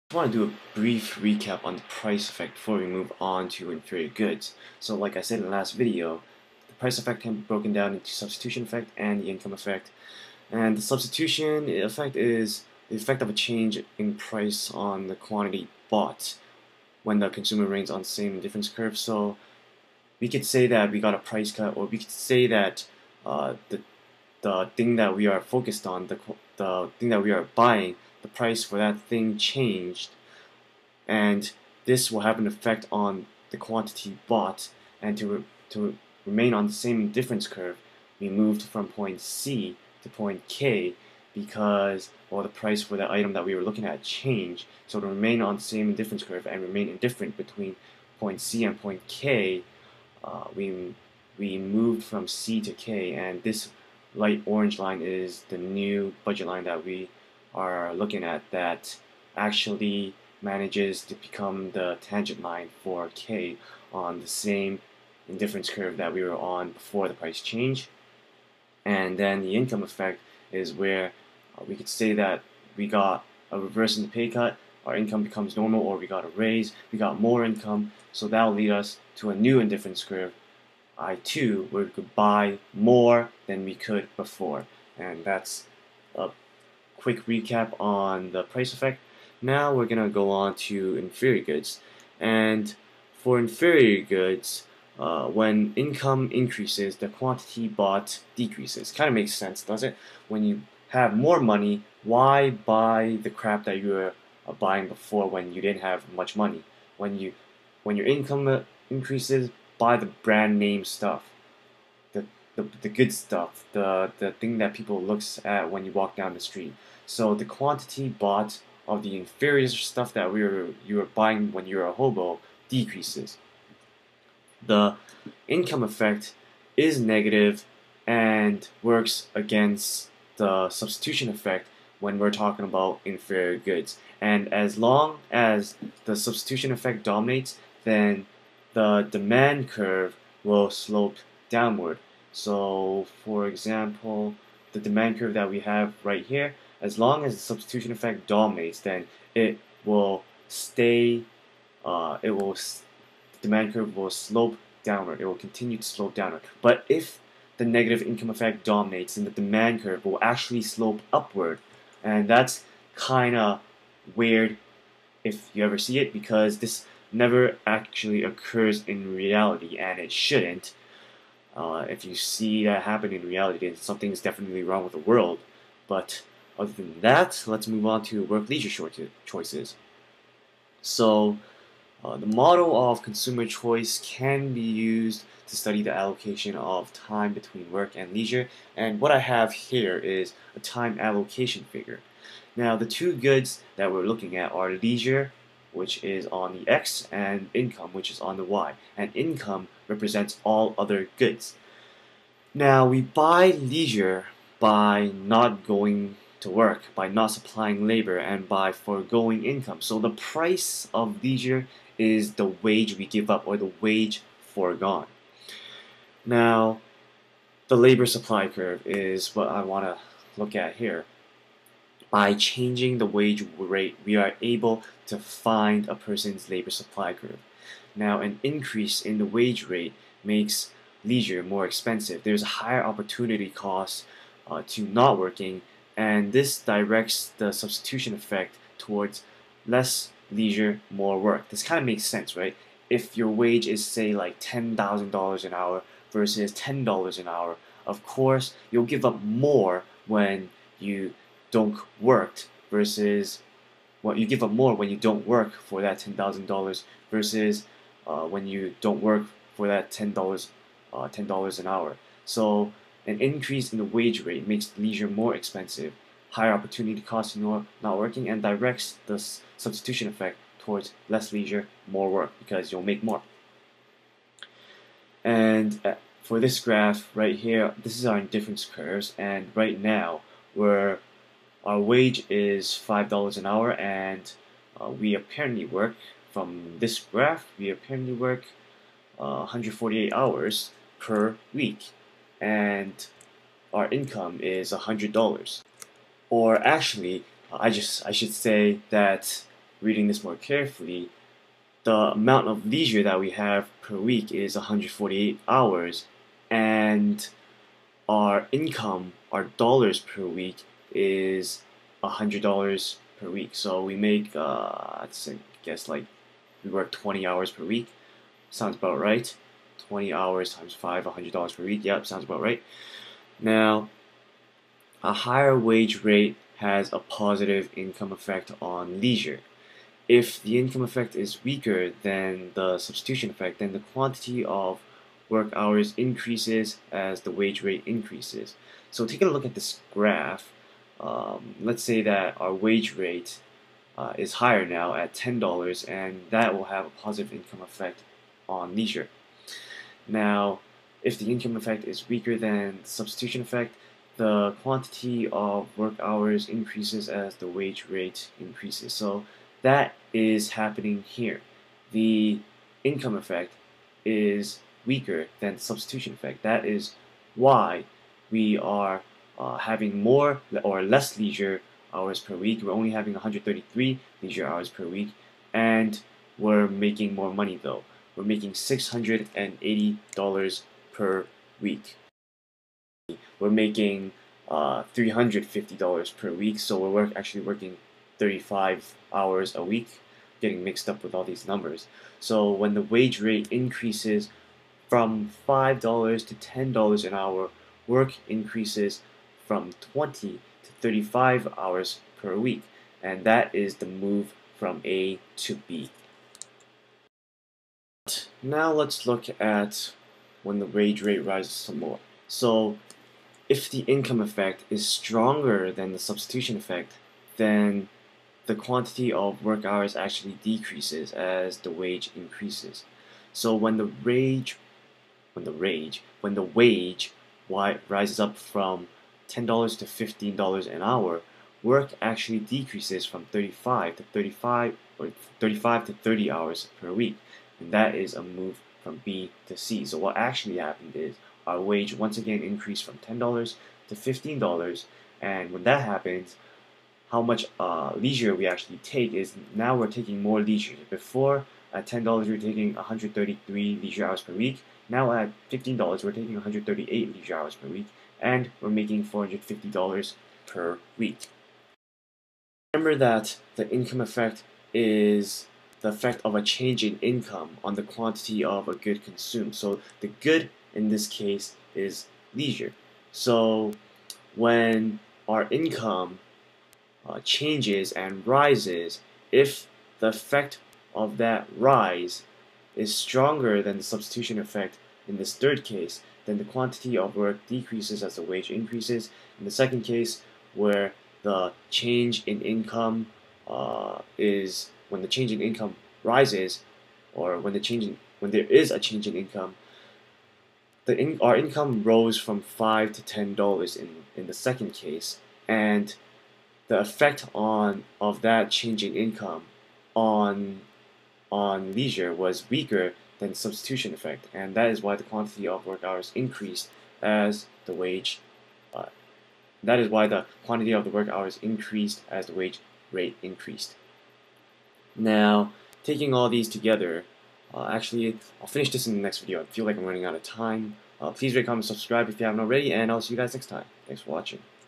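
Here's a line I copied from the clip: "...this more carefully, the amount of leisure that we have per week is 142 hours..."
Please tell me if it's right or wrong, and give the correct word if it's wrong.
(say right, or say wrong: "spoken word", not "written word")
wrong: "148", not "142".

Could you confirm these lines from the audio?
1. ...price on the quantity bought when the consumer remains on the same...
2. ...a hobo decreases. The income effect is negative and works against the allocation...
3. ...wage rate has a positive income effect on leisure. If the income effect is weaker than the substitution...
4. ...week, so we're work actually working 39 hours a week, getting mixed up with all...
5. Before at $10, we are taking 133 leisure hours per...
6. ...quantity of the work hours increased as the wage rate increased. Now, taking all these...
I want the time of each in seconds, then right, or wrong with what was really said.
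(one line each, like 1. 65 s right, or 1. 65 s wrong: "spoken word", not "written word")
1. 14 s right
2. 121 s wrong: "substitution", not "allocation"
3. 325 s right
4. 386 s wrong: "35", not "39"
5. 450 s right
6. 520 s right.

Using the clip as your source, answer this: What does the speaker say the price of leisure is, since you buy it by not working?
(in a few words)
The wage foregone.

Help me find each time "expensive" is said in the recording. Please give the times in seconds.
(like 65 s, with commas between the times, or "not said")
231 s, 265 s.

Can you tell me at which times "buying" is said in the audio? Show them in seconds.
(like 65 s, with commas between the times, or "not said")
27 s, 104 s, 121 s.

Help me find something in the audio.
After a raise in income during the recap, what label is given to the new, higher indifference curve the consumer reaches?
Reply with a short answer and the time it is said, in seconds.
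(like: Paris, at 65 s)
I2, at 80 s.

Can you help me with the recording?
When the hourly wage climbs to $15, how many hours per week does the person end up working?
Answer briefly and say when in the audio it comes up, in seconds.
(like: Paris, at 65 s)
30 hours, at 435 s.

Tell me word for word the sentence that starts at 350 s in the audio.
Now, if the income effect is weaker than substitution effect, the quantity of work hours increases as the wage rate increases.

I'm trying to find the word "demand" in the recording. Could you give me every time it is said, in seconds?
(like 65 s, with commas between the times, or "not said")
139 s, 144 s, 153 s, 159 s.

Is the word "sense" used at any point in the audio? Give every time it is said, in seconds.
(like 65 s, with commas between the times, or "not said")
99 s, 242 s.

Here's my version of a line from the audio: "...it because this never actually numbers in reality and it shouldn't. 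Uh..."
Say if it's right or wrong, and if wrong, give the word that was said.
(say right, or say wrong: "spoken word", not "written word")
wrong: "occurs", not "numbers".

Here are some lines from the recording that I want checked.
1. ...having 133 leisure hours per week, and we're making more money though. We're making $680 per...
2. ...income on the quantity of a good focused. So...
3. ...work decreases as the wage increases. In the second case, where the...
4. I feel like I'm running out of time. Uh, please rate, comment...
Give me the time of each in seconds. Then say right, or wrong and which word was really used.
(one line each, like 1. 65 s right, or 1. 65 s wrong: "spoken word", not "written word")
1. 372 s right
2. 467 s wrong: "consumed", not "focused"
3. 487 s right
4. 529 s right.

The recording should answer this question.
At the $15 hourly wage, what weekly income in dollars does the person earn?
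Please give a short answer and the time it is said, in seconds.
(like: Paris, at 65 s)
$450, at 459 s.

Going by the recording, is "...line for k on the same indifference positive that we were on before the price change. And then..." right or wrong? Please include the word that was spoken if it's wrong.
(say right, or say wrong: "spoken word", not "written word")
wrong: "curve", not "positive".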